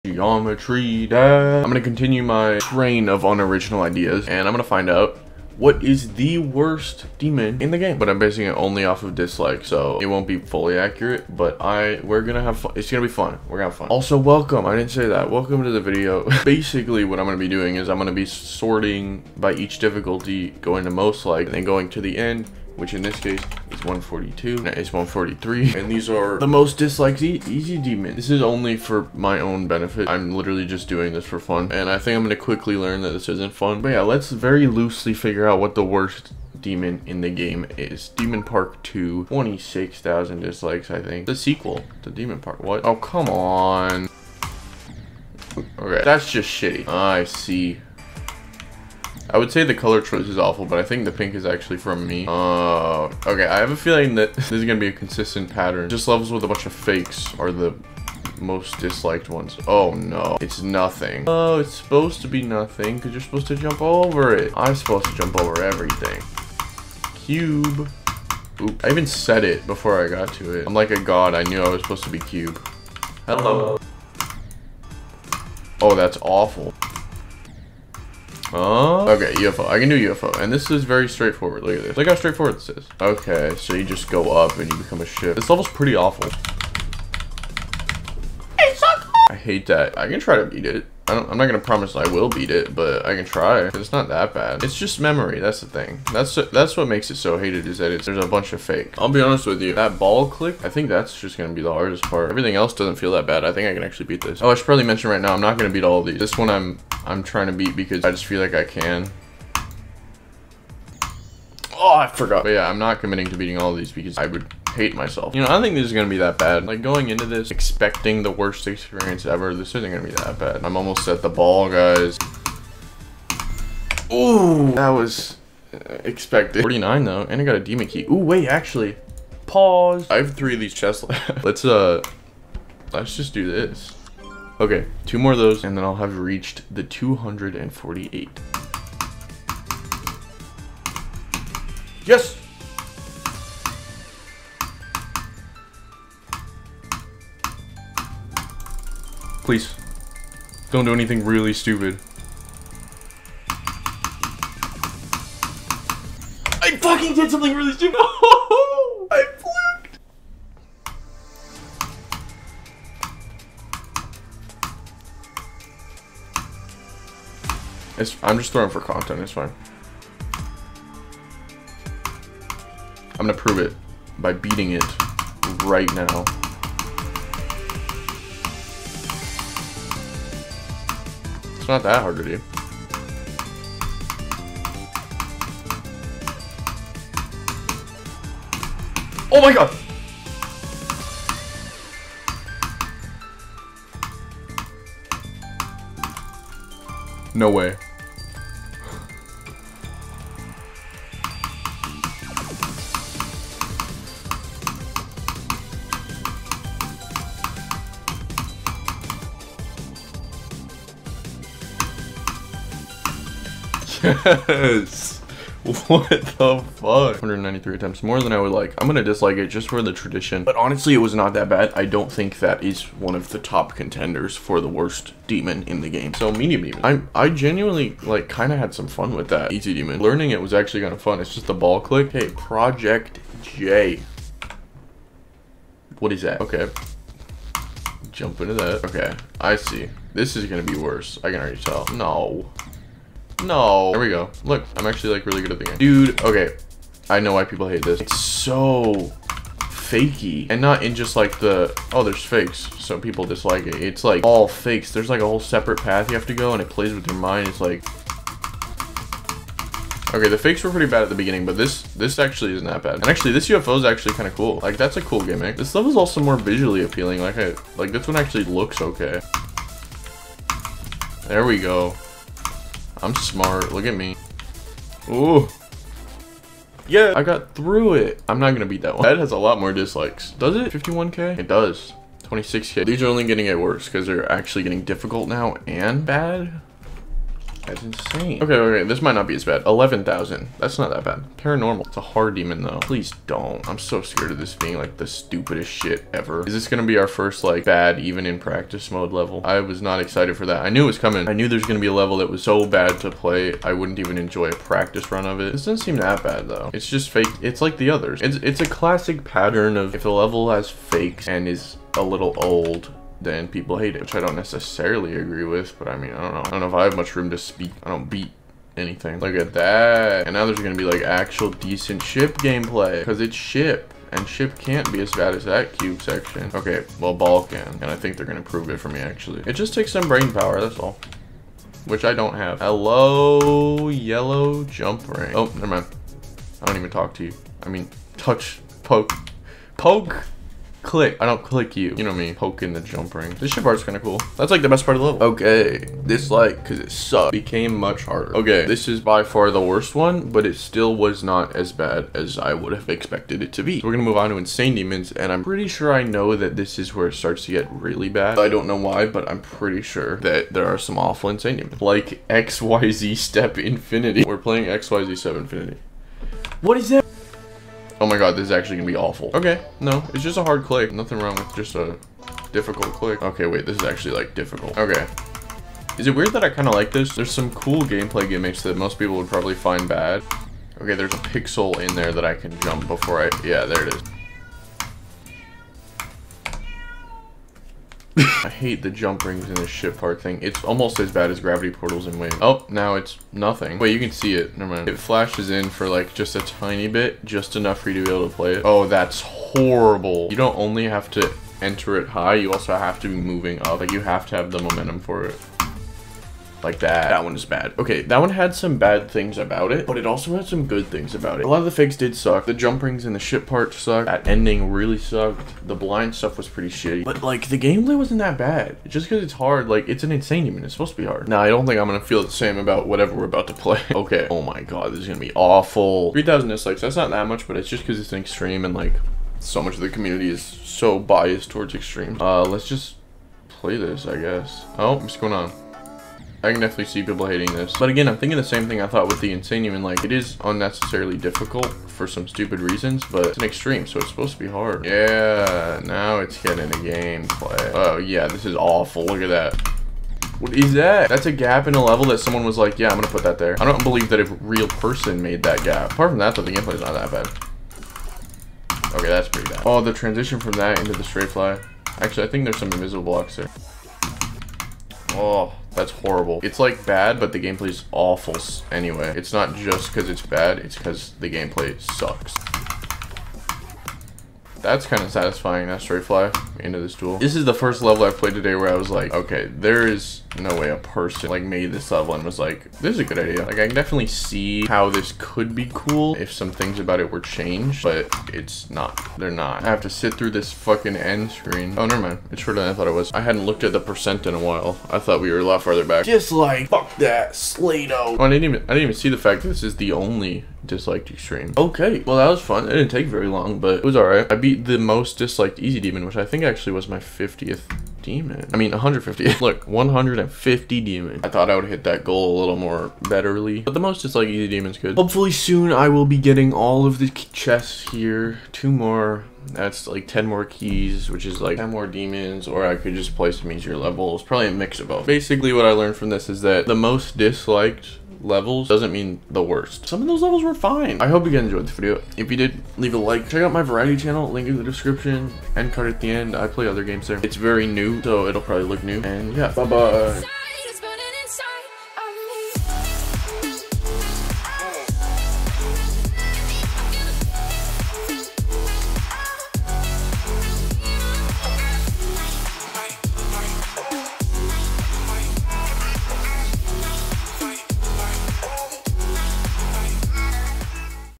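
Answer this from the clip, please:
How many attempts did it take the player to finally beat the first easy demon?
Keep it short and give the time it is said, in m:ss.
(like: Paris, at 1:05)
193, at 3:37.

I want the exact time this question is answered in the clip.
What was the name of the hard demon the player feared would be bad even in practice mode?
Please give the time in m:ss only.
4:51.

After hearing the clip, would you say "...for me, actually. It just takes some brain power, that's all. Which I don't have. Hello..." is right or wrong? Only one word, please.
right.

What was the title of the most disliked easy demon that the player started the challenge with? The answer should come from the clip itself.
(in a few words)
Demon Park 2.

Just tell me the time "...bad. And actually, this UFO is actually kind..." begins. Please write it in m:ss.
4:22.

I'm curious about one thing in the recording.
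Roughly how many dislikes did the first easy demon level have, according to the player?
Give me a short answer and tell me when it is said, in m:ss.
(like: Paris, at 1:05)
26,000, at 0:39.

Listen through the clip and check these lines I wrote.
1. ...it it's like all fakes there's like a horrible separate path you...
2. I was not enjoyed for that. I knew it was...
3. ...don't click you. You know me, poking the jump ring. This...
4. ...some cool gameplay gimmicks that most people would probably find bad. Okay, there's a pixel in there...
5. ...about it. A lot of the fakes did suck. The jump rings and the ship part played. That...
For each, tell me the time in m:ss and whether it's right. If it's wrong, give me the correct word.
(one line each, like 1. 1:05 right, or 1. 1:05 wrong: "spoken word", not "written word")
1. 4:13 wrong: "whole", not "horrible"
2. 4:59 wrong: "excited", not "enjoyed"
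3. 5:41 right
4. 6:17 right
5. 6:51 wrong: "sucked", not "played".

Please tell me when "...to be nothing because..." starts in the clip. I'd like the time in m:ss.
1:02.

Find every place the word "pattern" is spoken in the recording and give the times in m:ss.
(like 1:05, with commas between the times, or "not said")
0:55, 5:09.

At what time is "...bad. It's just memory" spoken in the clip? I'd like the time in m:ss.
1:34.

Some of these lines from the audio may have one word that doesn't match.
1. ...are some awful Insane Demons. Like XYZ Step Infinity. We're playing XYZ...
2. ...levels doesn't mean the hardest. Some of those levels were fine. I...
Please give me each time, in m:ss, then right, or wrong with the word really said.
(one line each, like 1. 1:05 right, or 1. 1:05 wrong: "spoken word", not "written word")
1. 6:00 right
2. 8:48 wrong: "worst", not "hardest".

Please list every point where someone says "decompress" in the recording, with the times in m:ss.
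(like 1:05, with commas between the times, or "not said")
not said.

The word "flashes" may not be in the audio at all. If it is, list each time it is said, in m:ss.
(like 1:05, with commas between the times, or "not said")
6:34.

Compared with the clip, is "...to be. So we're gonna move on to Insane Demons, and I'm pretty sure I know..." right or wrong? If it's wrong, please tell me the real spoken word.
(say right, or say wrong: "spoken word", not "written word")
right.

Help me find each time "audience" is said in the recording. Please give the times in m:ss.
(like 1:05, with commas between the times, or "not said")
not said.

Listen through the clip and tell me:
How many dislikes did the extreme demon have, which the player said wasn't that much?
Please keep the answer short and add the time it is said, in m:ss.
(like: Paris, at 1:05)
3,000, at 7:06.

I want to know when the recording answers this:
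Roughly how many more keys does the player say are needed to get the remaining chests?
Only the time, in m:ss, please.
8:40.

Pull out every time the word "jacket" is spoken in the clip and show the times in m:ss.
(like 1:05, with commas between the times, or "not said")
not said.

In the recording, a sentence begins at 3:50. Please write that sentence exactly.
Learning it was actually kind of fun.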